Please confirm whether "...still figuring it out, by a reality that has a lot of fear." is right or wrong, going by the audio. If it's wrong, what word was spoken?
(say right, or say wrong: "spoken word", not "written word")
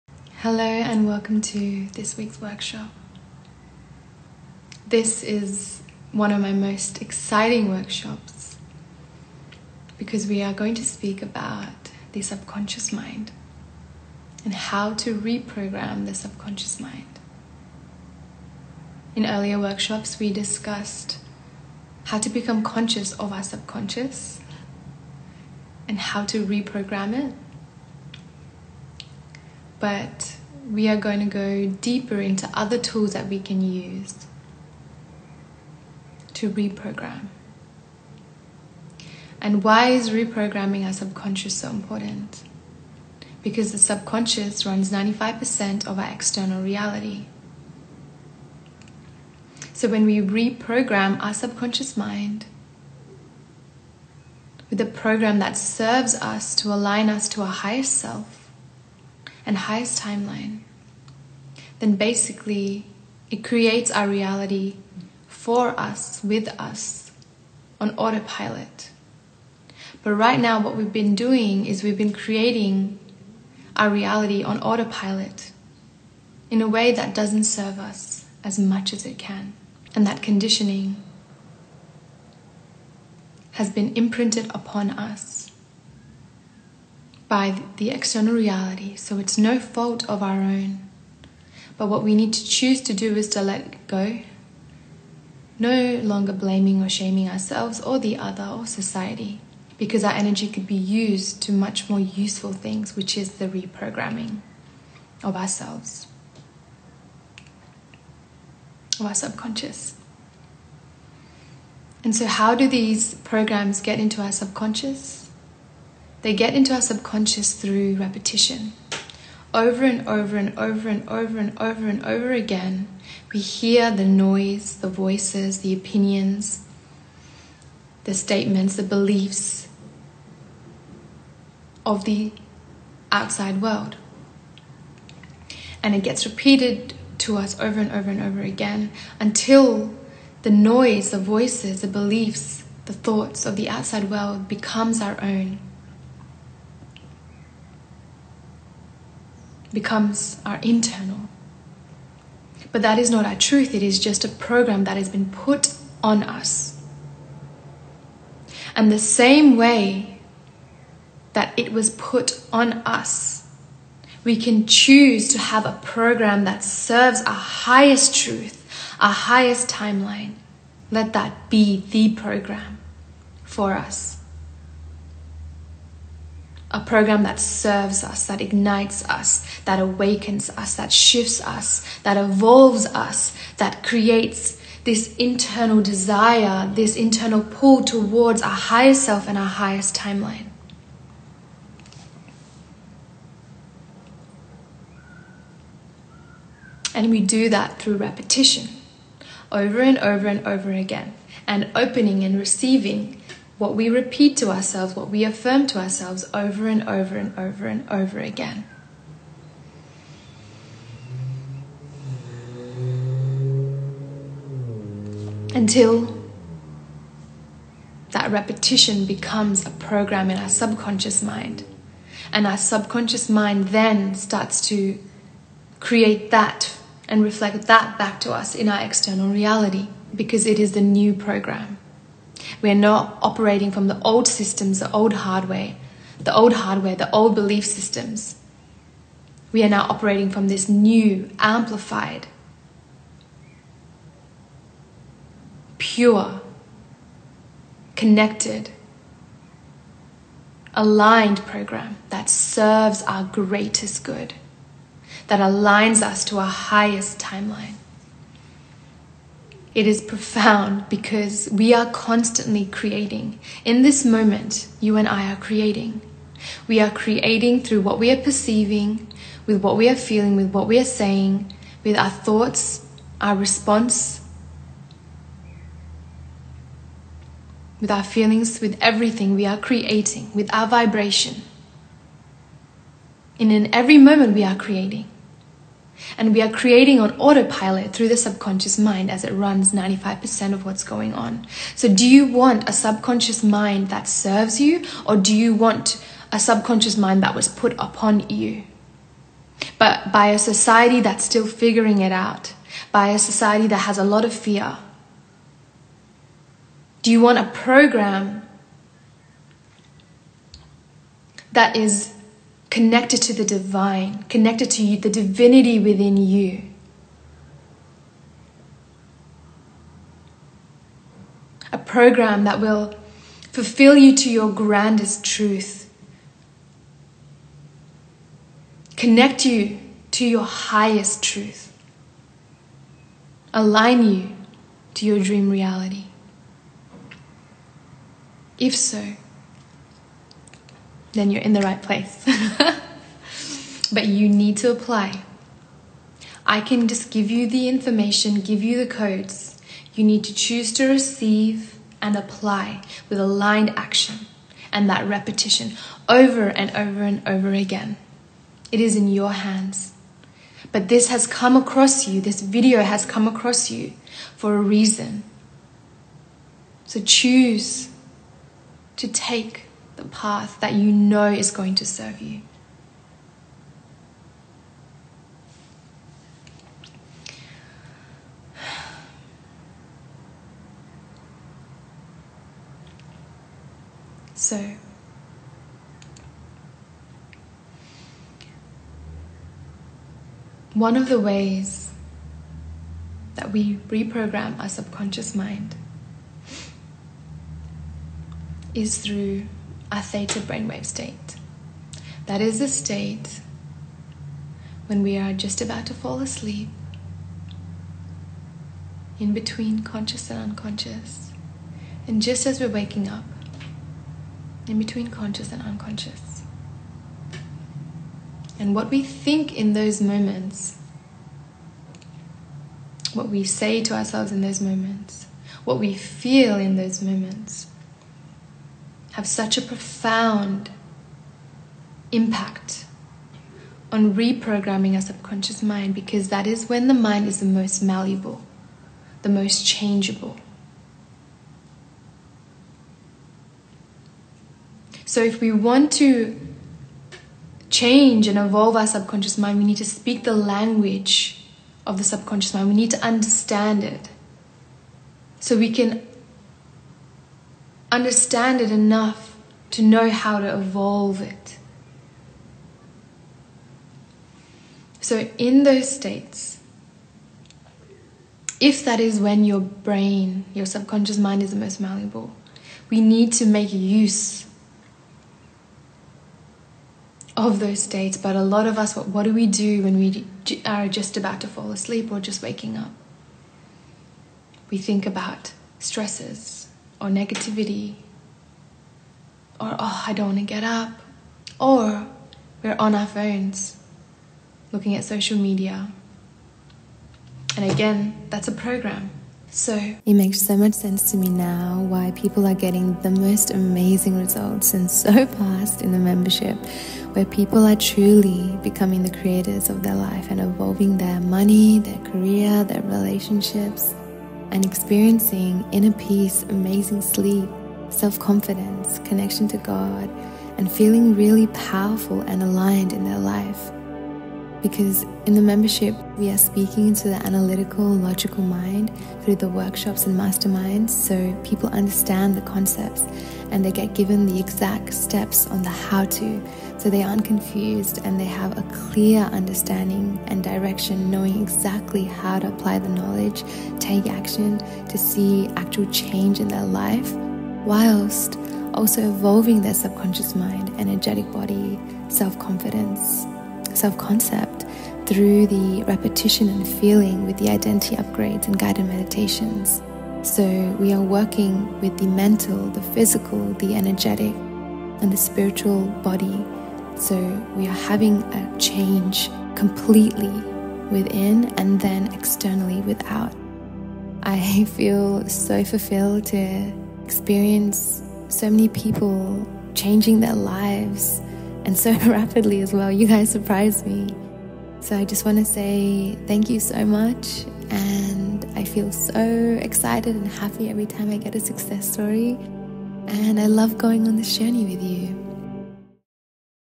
wrong: "society", not "reality".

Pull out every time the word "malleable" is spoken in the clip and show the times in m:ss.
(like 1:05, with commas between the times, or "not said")
7:17, 7:51.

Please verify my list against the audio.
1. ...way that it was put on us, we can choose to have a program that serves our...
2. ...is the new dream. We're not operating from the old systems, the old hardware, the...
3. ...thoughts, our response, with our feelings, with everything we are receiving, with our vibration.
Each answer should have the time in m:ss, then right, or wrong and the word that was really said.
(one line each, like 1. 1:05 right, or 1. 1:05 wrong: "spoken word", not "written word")
1. 2:39 right
2. 3:50 wrong: "program", not "dream"
3. 4:32 wrong: "creating", not "receiving".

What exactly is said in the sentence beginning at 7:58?
But a lot of us, what, what do we do when we are just about to fall asleep or just waking up?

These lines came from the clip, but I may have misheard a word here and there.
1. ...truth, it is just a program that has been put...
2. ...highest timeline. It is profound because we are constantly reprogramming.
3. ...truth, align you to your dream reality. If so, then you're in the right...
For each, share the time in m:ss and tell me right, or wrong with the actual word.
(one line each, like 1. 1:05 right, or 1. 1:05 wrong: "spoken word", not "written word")
1. 2:33 right
2. 4:16 wrong: "creating", not "reprogramming"
3. 5:31 right.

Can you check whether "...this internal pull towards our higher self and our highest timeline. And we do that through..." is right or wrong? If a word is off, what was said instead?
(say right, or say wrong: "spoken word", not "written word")
right.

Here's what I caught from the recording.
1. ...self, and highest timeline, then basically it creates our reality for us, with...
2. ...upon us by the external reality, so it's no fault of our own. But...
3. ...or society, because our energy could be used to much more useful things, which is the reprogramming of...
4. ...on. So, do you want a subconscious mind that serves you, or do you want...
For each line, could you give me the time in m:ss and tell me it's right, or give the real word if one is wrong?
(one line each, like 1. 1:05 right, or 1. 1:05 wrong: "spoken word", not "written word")
1. 0:57 right
2. 1:24 right
3. 1:38 right
4. 4:51 right.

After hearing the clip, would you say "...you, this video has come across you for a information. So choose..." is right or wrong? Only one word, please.
wrong.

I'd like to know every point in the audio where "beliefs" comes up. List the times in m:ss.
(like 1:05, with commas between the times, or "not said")
2:08, 2:21, 3:57.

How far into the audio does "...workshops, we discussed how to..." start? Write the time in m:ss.
0:19.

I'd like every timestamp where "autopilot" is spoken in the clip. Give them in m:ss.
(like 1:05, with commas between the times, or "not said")
1:07, 1:14, 4:47.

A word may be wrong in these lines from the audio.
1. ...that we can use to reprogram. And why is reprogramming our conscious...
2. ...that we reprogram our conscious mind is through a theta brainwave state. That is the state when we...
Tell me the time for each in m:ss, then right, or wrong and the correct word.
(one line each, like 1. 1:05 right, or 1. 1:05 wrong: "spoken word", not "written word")
1. 0:33 wrong: "subconscious", not "conscious"
2. 6:33 wrong: "subconscious", not "conscious".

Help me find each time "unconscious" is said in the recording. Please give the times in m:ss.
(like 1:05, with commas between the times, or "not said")
6:50, 6:55.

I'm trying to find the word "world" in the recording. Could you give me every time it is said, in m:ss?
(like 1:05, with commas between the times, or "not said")
2:13, 2:24.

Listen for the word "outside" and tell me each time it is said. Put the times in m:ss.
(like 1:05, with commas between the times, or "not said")
2:13, 2:23.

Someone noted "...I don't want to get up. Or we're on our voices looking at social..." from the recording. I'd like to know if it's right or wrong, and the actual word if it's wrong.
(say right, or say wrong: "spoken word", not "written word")
wrong: "phones", not "voices".